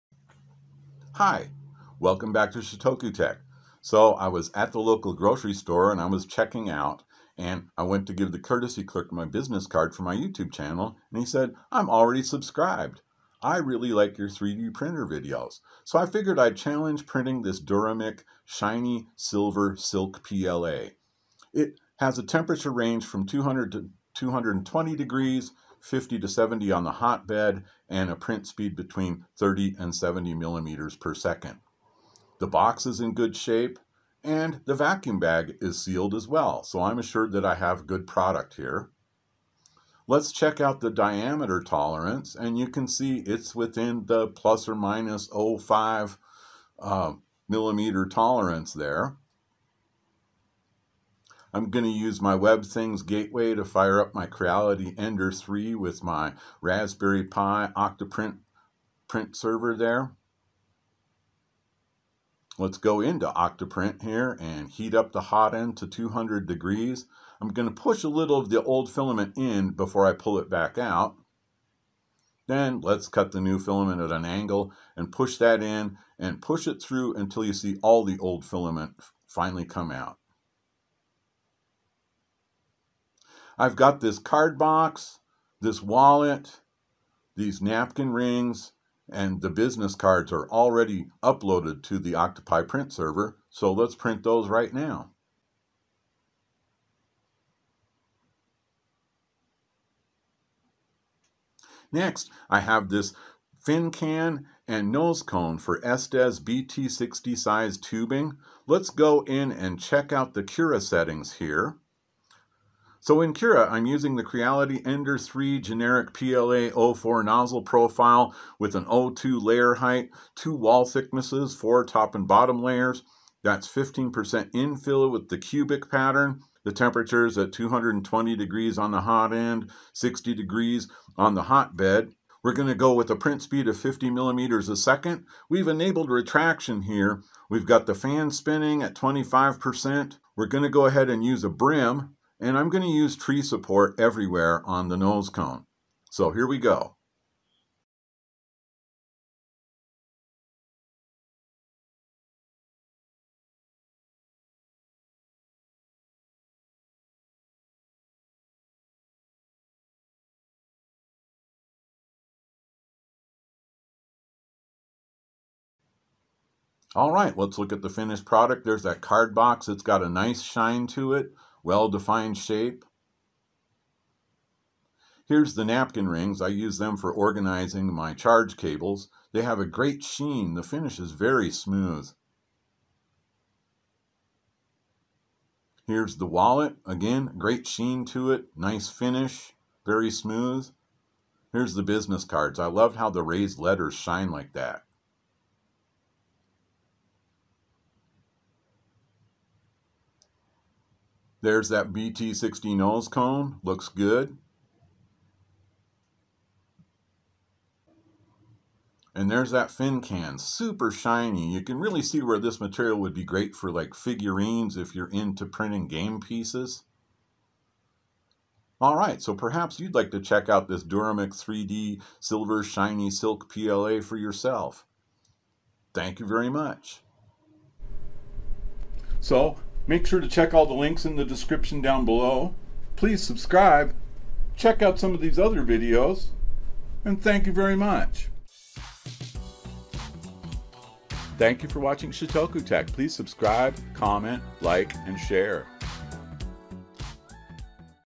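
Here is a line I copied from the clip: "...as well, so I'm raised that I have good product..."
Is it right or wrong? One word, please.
wrong.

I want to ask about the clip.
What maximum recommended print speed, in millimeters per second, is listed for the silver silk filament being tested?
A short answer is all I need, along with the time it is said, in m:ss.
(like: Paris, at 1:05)
70, at 0:29.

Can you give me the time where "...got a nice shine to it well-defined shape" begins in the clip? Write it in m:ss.
2:49.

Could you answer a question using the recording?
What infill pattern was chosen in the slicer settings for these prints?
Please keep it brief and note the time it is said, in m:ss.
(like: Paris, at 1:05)
cubic, at 2:05.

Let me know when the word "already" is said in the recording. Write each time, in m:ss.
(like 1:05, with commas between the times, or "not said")
0:11, 1:30.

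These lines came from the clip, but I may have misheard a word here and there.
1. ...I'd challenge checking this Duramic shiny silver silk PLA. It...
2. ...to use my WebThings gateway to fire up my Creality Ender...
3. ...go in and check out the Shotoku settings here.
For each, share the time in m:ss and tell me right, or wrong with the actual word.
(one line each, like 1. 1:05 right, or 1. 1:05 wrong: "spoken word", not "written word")
1. 0:16 wrong: "printing", not "checking"
2. 0:51 right
3. 1:48 wrong: "Cura", not "Shotoku".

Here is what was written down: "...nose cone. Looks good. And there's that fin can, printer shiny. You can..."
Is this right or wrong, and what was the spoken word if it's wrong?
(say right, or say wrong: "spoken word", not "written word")
wrong: "super", not "printer".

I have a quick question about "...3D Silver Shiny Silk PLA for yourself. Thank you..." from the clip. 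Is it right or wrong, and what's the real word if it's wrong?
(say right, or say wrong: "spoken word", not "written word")
right.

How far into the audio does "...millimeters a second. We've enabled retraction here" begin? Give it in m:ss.
2:14.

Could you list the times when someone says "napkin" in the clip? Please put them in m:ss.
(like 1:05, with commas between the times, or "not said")
1:27, 2:55.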